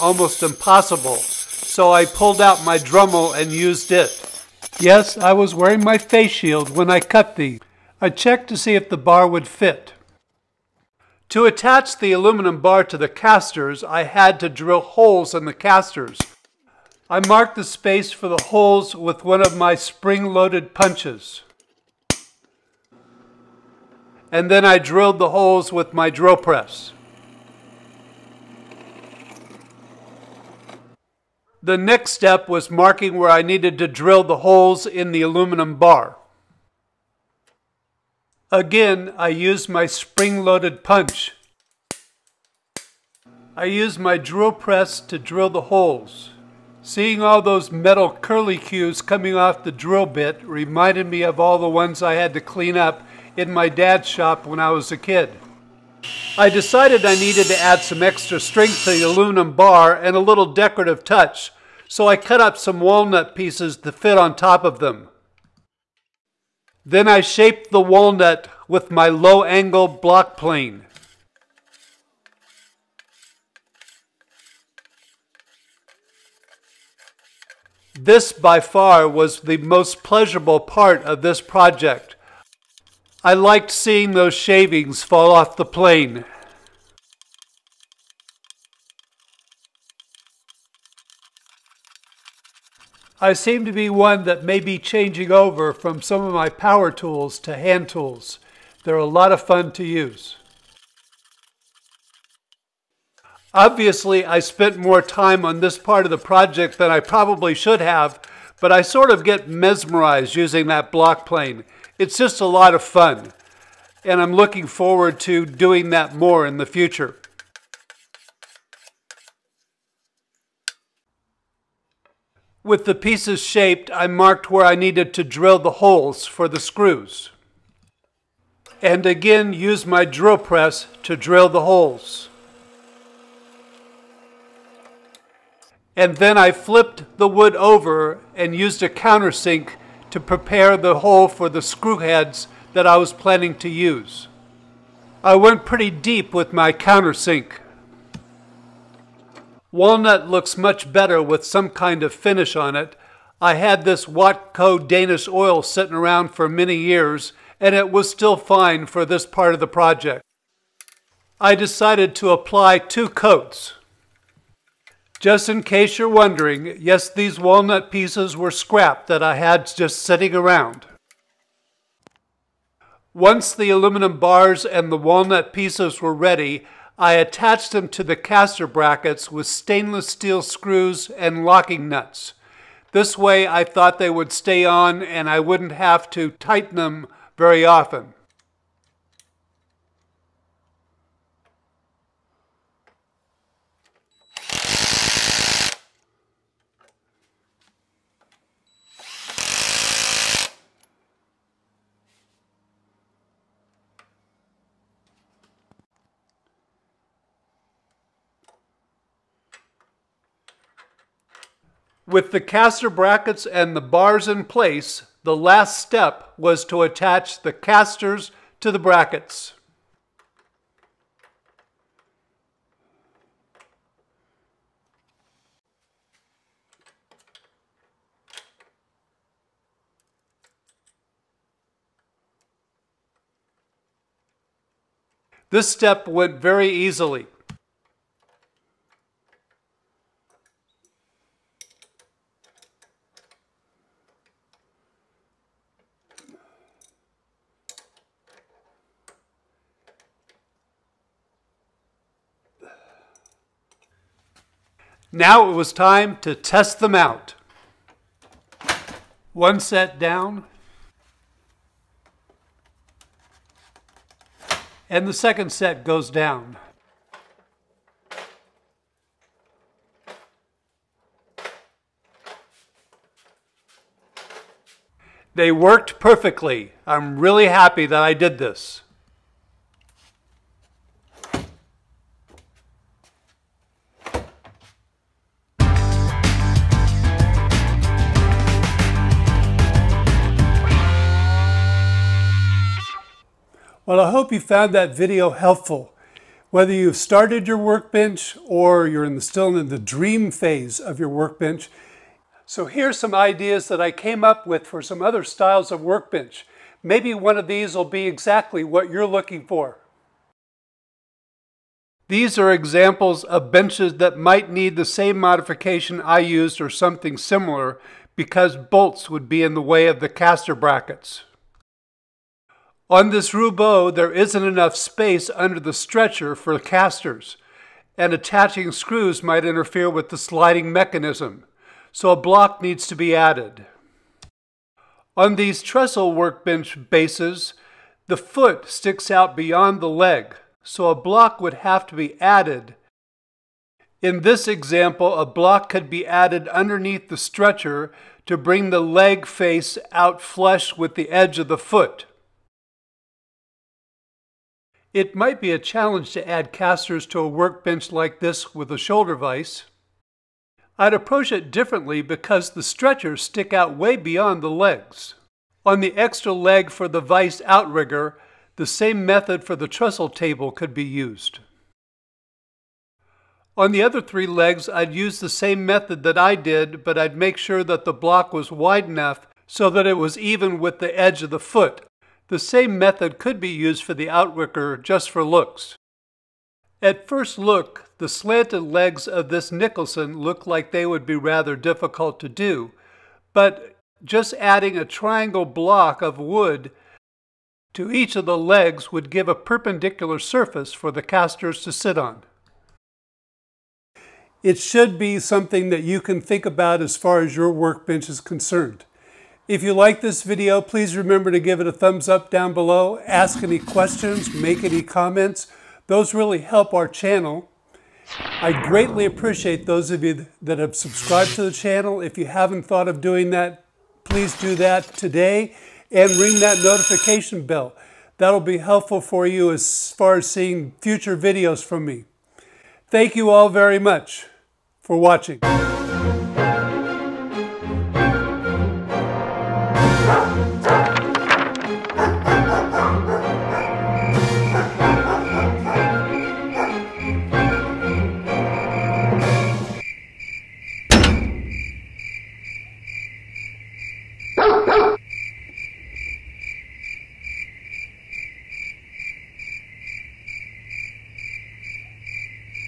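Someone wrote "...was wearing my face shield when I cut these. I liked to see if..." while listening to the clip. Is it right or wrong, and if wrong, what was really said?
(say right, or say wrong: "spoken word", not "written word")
wrong: "checked", not "liked".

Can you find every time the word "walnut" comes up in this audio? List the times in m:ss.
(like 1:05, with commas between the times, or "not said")
1:02, 1:07, 2:29, 2:47, 2:54.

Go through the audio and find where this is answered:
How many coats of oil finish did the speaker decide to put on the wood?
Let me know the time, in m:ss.
2:42.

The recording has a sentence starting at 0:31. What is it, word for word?
The next step was marking where I needed to drill the holes in the aluminum bar.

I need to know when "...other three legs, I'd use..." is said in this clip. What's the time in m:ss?
6:13.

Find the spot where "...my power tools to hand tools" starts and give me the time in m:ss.
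1:36.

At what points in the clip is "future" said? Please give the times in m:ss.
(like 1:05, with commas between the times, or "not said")
1:56, 7:10.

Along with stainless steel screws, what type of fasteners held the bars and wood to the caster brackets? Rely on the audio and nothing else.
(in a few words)
Locking nuts.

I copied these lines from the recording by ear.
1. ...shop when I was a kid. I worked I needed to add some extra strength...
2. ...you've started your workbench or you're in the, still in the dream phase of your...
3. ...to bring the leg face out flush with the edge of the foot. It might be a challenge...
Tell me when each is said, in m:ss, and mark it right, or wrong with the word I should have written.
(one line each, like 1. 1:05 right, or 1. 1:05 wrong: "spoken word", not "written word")
1. 0:54 wrong: "decided", not "worked"
2. 4:56 right
3. 5:48 right.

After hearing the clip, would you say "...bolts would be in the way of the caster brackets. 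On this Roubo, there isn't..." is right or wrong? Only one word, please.
right.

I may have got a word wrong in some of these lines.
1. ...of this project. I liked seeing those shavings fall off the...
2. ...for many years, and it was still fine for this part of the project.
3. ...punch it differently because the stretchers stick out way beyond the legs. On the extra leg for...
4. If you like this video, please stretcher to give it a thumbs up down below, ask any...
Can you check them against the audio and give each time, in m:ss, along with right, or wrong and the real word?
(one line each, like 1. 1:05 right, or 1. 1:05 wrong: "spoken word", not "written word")
1. 1:21 right
2. 2:36 right
3. 6:00 wrong: "approach", not "punch"
4. 6:49 wrong: "remember", not "stretcher".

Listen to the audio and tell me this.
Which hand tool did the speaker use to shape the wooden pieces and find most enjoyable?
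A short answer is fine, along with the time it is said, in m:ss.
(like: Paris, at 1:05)
Low angle block plane, at 1:09.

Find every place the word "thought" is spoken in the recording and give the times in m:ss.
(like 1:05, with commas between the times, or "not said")
3:03, 7:02.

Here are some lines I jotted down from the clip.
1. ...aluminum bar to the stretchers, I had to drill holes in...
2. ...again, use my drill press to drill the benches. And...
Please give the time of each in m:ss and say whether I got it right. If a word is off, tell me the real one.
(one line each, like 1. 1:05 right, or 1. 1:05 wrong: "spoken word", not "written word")
1. 0:12 wrong: "casters", not "stretchers"
2. 2:09 wrong: "holes", not "benches".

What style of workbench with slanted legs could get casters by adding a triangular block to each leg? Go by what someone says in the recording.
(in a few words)
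Nicholson.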